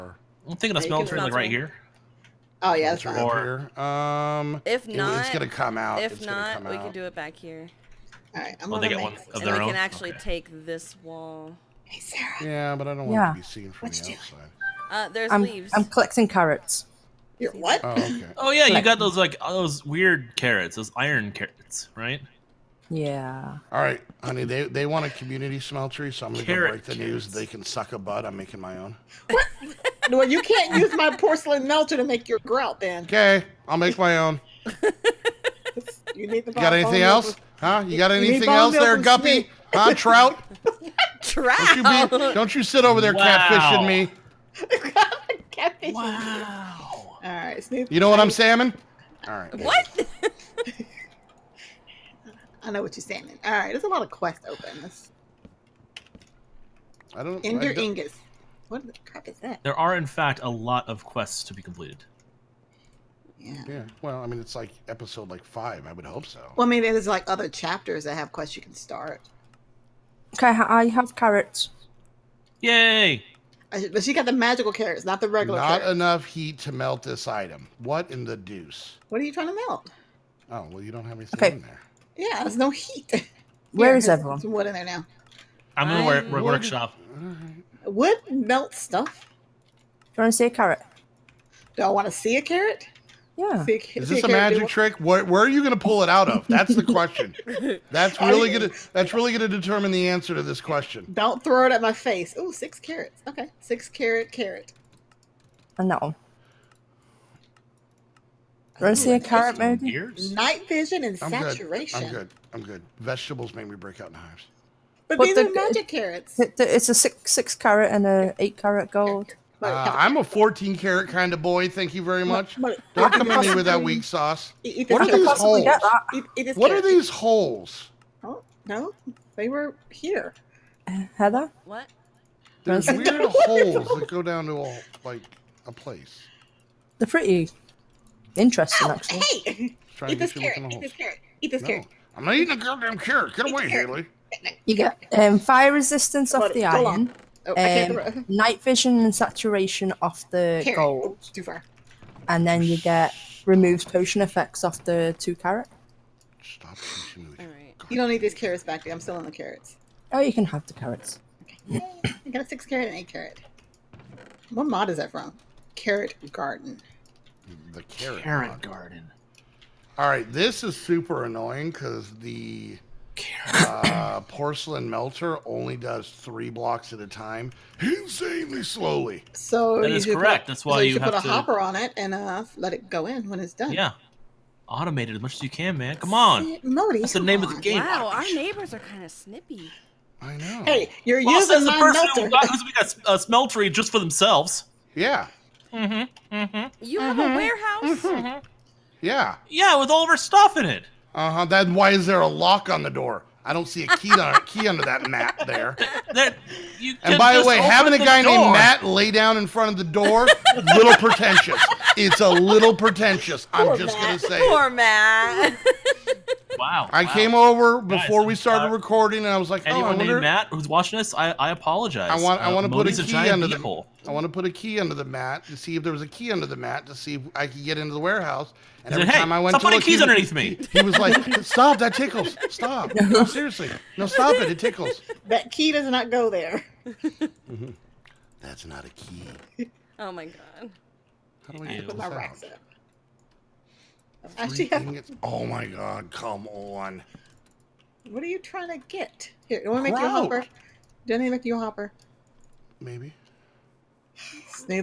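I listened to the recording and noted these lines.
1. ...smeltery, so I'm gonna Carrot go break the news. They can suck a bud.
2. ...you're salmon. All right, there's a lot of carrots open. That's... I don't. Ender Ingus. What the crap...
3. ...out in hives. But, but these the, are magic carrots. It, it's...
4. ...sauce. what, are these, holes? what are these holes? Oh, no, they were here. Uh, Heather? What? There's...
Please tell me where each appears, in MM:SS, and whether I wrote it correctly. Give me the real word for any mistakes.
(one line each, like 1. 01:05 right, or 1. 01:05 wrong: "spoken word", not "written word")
1. 00:25 right
2. 00:52 wrong: "quests", not "carrots"
3. 01:53 right
4. 02:04 right.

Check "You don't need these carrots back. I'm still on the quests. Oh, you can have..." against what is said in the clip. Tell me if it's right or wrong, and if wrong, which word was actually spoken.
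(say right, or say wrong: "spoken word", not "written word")
wrong: "carrots", not "quests".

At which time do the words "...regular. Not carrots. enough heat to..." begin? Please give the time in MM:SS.
01:15.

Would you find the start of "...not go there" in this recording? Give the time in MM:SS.
03:55.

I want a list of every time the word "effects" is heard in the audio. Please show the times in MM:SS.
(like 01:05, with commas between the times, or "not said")
02:34.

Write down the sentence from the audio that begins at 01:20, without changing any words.
Oh well, you don't have anything okay.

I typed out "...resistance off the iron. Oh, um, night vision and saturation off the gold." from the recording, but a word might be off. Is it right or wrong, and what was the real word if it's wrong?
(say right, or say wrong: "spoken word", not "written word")
right.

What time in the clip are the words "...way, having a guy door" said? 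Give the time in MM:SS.
03:27.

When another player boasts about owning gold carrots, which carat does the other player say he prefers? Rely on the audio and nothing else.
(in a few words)
14.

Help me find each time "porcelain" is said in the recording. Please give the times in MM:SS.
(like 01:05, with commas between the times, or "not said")
00:31, 02:54, 03:11.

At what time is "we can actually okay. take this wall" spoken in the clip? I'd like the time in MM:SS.
00:09.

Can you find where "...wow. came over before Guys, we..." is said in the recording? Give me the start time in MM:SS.
03:37.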